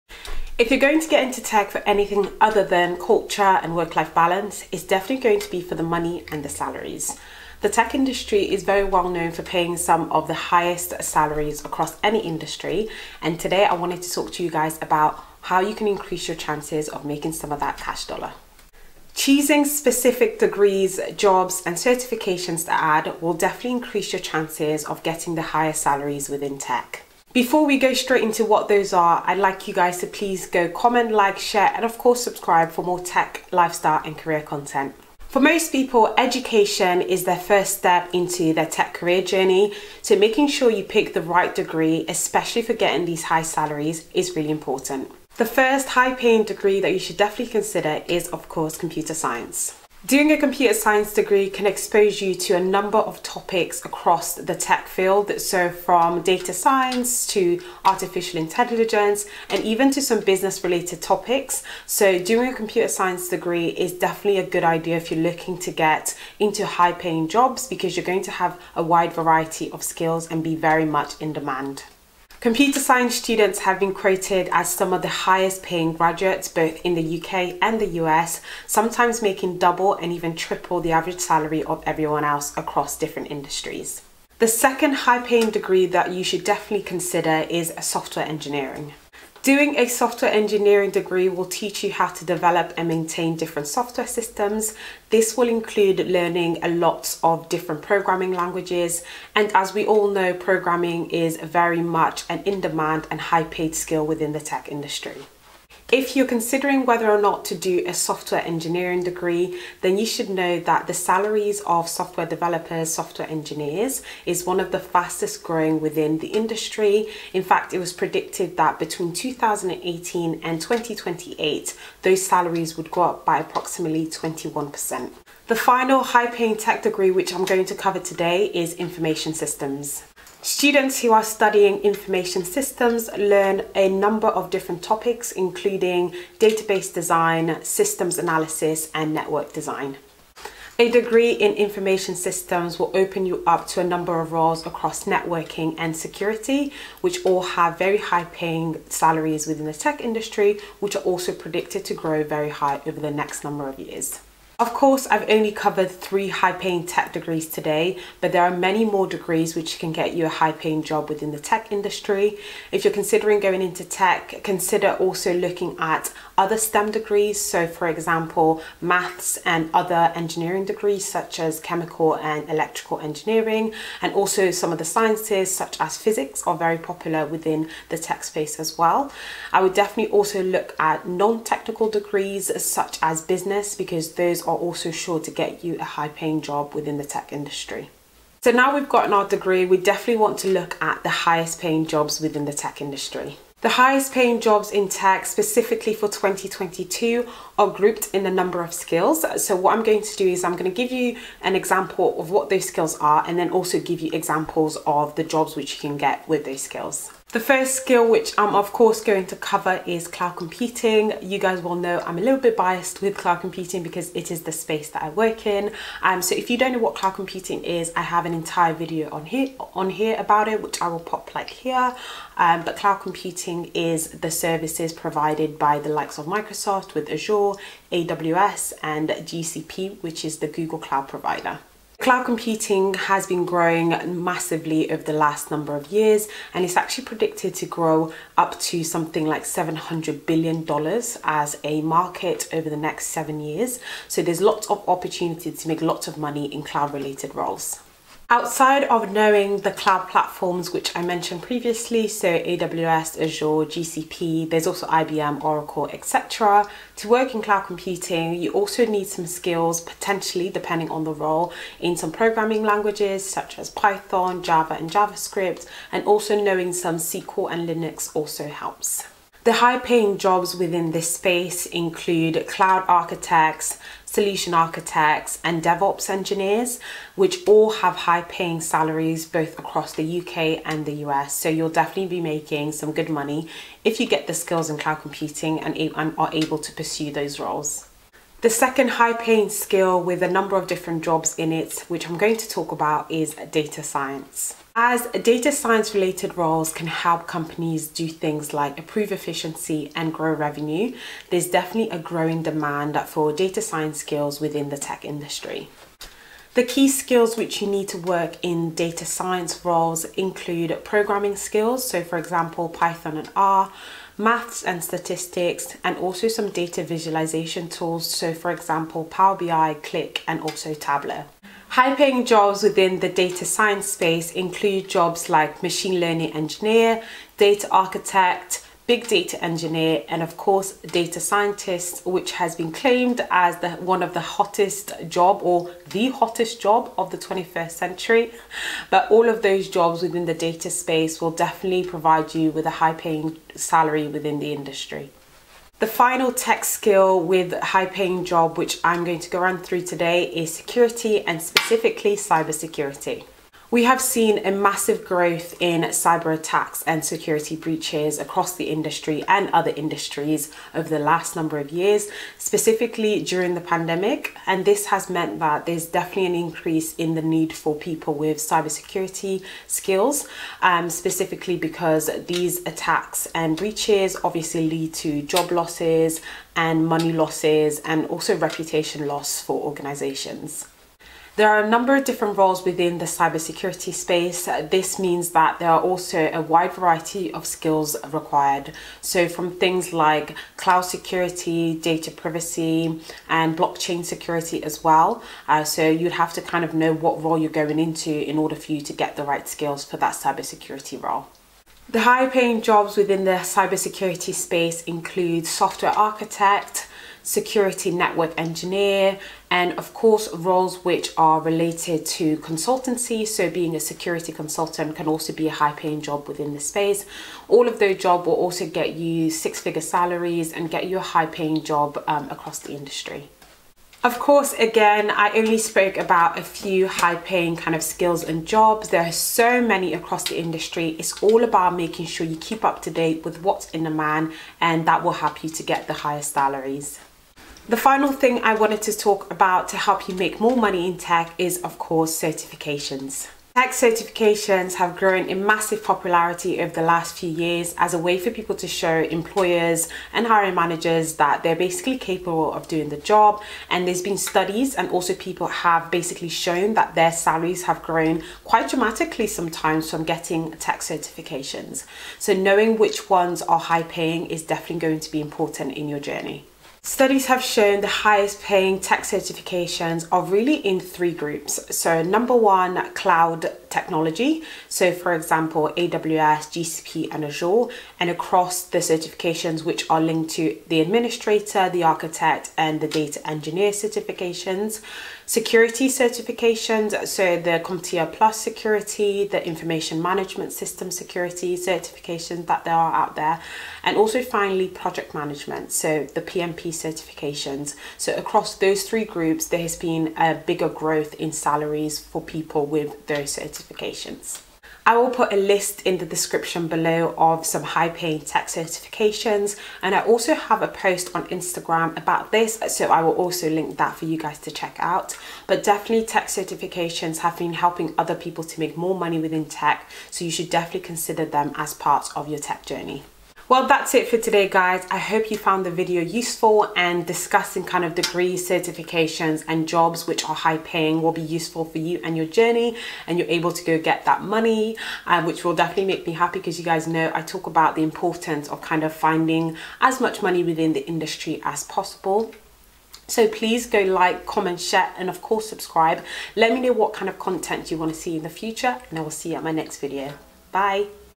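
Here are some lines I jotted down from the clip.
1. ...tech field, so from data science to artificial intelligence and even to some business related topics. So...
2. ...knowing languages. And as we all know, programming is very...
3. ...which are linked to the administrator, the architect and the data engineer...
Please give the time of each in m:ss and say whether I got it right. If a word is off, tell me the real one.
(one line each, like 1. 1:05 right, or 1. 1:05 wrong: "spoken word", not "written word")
1. 0:54 right
2. 1:37 wrong: "programming", not "knowing"
3. 7:59 right.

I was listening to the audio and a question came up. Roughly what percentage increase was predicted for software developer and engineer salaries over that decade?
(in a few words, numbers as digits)
21%.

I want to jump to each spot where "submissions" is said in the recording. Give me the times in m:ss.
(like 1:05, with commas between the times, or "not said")
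not said.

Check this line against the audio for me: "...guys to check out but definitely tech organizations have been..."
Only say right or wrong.
wrong.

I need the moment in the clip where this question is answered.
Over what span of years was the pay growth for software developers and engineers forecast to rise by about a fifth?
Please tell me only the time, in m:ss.
1:58.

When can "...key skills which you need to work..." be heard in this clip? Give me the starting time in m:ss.
5:06.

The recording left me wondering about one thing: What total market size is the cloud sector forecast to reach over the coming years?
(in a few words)
$700 billion.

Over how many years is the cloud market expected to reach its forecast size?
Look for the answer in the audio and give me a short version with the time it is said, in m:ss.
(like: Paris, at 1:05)
7, at 4:03.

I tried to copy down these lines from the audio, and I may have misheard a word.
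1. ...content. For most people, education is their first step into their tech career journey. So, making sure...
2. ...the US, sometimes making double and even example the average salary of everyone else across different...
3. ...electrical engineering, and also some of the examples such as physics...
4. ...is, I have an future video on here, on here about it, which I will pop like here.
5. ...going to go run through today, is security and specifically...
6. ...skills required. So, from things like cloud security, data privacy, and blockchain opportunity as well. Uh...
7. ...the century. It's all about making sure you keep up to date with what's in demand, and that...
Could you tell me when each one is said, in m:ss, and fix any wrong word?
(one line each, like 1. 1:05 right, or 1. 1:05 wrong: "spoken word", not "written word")
1. 0:34 right
2. 1:17 wrong: "triple", not "example"
3. 2:52 wrong: "sciences", not "examples"
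4. 3:37 wrong: "entire", not "future"
5. 5:49 right
6. 6:27 wrong: "security", not "opportunity"
7. 7:10 wrong: "industry", not "century".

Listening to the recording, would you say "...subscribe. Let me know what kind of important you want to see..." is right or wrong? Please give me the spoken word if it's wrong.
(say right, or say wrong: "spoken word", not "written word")
wrong: "content", not "important".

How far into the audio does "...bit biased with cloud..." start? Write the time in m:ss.
3:32.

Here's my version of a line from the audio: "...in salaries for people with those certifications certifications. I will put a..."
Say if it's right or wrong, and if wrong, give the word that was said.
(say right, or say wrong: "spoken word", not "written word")
right.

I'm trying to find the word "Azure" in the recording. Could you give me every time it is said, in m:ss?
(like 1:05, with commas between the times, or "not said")
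3:47, 4:13, 7:57.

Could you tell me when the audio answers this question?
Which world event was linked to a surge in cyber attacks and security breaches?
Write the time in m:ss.
6:03.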